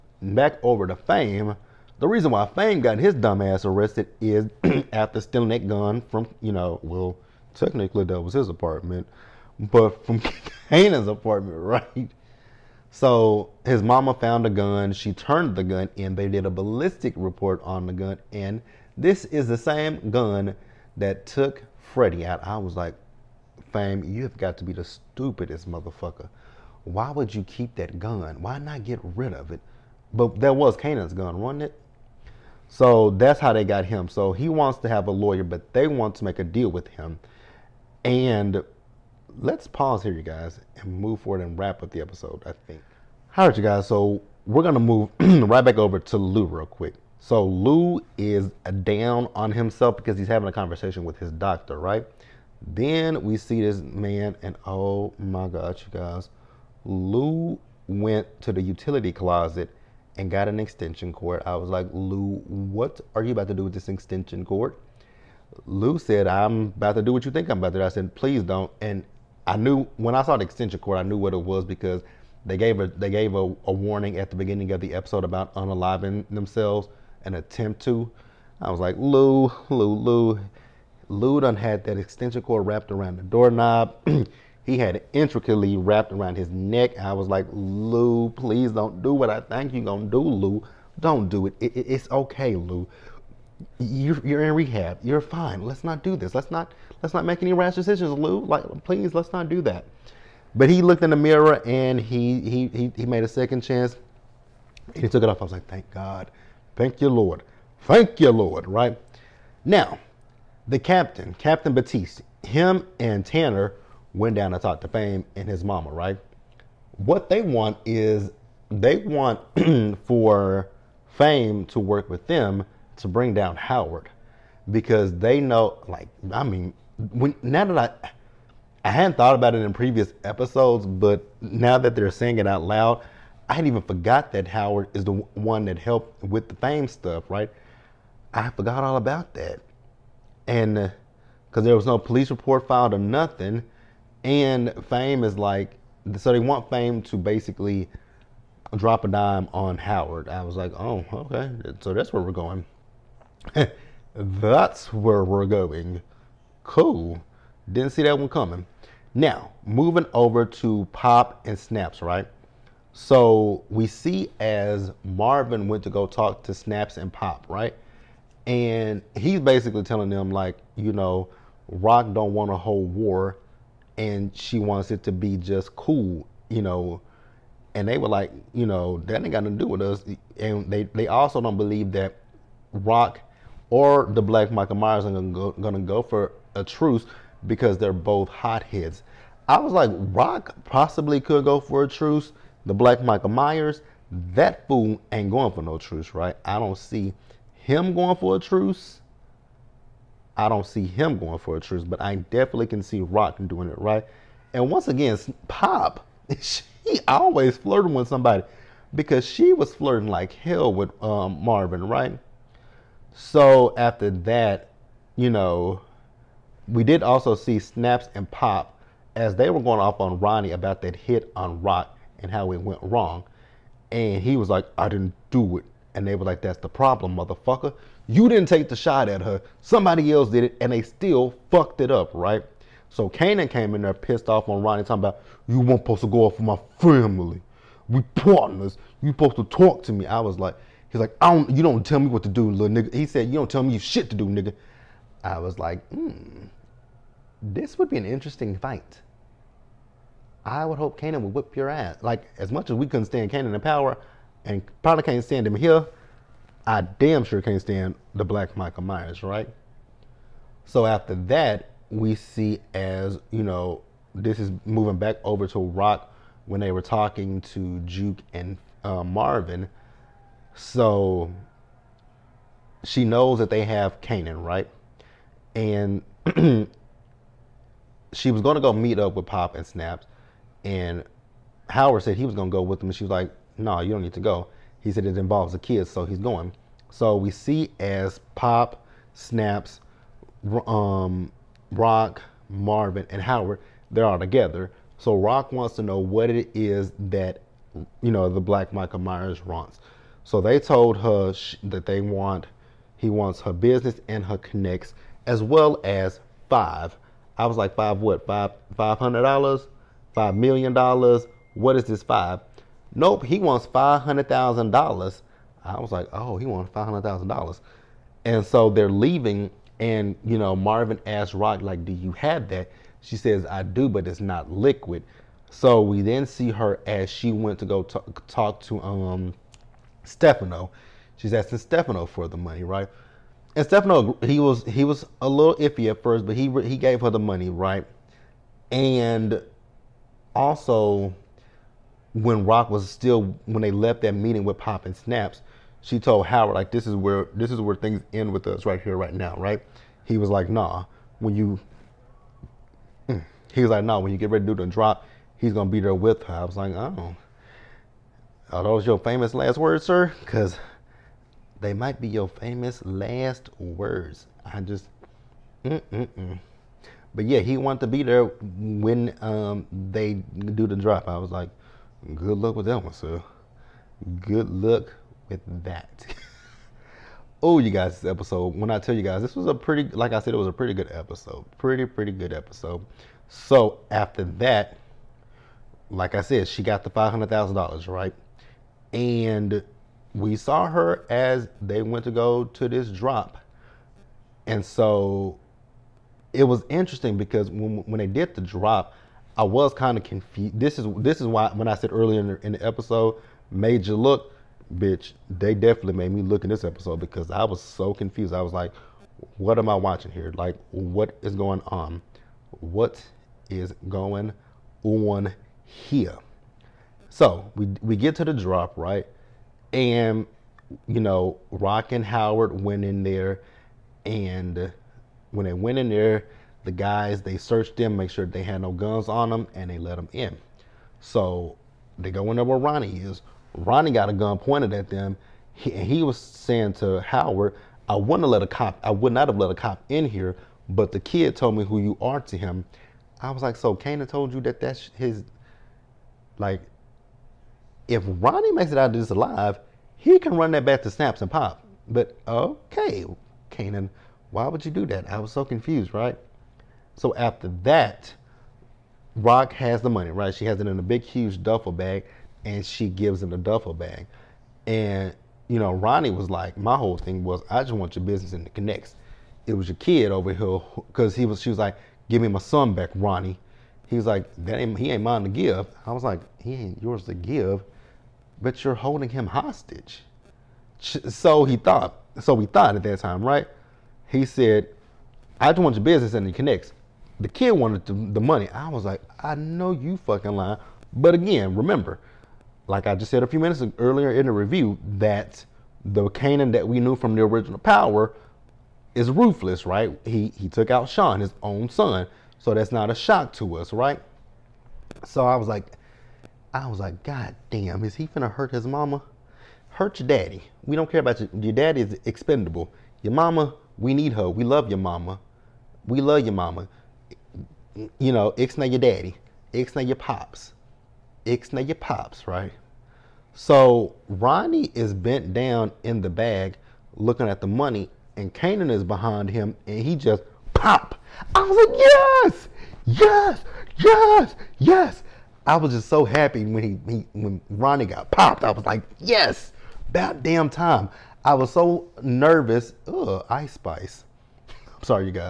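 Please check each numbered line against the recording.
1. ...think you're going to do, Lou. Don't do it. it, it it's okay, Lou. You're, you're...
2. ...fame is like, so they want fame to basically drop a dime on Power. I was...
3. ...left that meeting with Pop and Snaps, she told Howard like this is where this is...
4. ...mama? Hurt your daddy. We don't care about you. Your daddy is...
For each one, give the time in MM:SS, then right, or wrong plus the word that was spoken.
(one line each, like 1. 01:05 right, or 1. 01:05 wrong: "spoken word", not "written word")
1. 01:29 right
2. 02:24 wrong: "Howard", not "Power"
3. 05:43 right
4. 08:28 right.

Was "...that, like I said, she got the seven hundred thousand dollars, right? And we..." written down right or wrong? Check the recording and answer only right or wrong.
wrong.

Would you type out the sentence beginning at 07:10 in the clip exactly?
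So they go in there where Ronnie is.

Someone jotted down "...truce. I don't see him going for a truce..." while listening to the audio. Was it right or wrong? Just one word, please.
right.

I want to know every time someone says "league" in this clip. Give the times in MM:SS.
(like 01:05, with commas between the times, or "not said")
not said.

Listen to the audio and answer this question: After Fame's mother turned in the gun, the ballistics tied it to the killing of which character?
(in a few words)
Freddie.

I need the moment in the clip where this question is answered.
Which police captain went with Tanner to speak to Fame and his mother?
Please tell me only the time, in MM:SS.
01:51.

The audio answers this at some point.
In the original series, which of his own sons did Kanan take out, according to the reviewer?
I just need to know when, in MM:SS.
08:20.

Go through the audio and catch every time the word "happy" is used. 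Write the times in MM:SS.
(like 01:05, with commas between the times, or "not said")
08:56.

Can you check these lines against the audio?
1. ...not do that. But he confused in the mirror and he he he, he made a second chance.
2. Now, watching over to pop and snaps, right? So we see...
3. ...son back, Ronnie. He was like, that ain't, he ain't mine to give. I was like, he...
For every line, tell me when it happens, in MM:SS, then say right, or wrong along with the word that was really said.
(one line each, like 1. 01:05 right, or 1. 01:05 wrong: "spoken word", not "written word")
1. 01:39 wrong: "looked", not "confused"
2. 02:39 wrong: "moving", not "watching"
3. 07:52 right.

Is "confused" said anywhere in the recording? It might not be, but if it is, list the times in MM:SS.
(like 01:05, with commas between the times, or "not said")
06:40, 06:47, 07:35.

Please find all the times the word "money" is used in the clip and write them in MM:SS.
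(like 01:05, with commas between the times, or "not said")
05:32, 05:37, 07:39, 08:08, 08:47.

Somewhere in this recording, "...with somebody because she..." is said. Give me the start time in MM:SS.
03:27.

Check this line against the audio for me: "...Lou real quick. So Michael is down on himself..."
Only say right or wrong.
wrong.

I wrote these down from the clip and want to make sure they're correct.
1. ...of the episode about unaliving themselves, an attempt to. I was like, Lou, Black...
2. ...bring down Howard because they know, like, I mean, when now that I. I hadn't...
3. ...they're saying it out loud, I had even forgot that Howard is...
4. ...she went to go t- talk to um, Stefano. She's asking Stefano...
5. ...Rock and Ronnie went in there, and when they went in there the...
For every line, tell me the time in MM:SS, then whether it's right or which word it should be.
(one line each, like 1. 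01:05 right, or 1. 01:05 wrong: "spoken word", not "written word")
1. 01:14 wrong: "Lou", not "Black"
2. 02:03 right
3. 02:11 right
4. 05:27 right
5. 07:01 wrong: "Howard", not "Ronnie".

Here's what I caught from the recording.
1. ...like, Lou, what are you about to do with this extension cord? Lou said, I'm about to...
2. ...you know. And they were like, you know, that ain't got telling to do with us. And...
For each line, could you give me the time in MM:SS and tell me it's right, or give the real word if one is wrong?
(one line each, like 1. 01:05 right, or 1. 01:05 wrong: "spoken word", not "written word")
1. 01:01 right
2. 02:56 wrong: "nothing", not "telling".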